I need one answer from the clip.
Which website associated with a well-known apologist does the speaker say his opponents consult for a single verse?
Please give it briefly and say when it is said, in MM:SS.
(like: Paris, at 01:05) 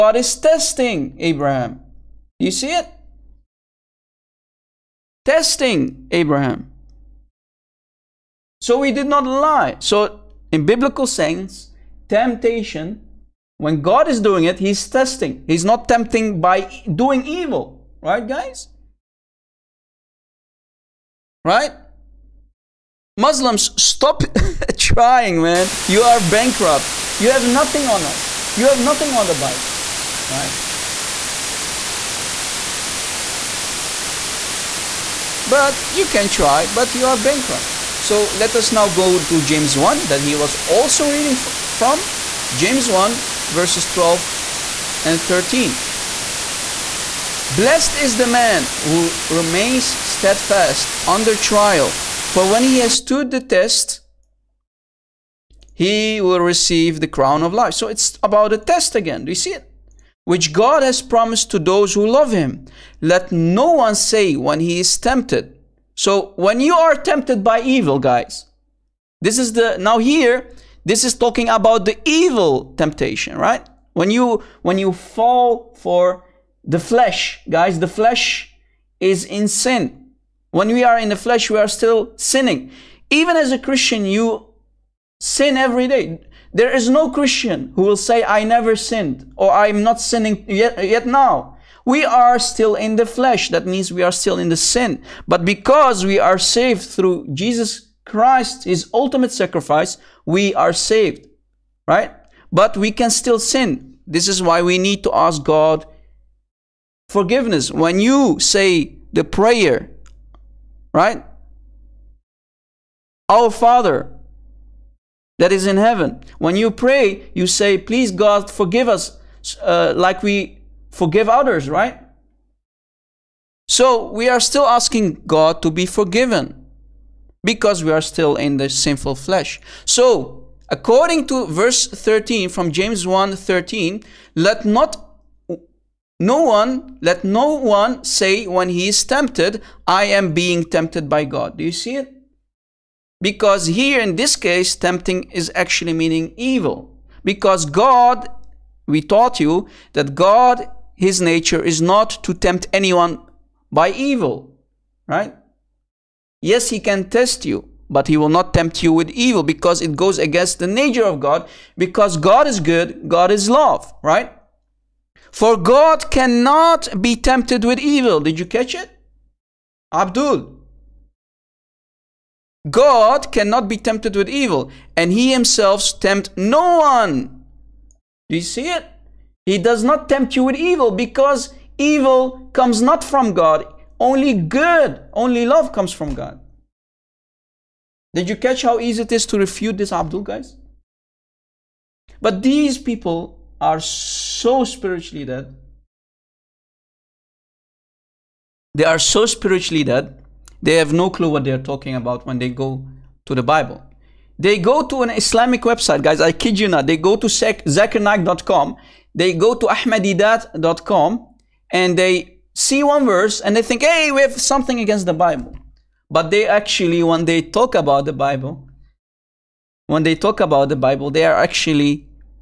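ahmadidat.com, at 03:29.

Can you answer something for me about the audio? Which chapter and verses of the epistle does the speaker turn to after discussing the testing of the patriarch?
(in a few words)
James 1:12-13.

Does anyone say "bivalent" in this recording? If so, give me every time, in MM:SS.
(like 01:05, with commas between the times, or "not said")
not said.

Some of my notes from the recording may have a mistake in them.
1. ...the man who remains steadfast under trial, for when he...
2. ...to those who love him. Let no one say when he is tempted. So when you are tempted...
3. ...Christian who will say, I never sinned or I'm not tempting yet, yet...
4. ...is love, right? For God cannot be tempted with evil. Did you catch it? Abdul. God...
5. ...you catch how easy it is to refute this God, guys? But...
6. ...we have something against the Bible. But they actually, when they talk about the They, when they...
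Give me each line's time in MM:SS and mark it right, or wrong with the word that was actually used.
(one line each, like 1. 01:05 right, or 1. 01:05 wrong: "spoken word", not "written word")
1. 00:48 right
2. 01:01 right
3. 01:27 wrong: "sinning", not "tempting"
4. 02:43 right
5. 03:08 wrong: "Abdul", not "God"
6. 03:34 wrong: "Bible", not "They".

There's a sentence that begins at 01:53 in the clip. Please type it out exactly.
Our Father that is in heaven.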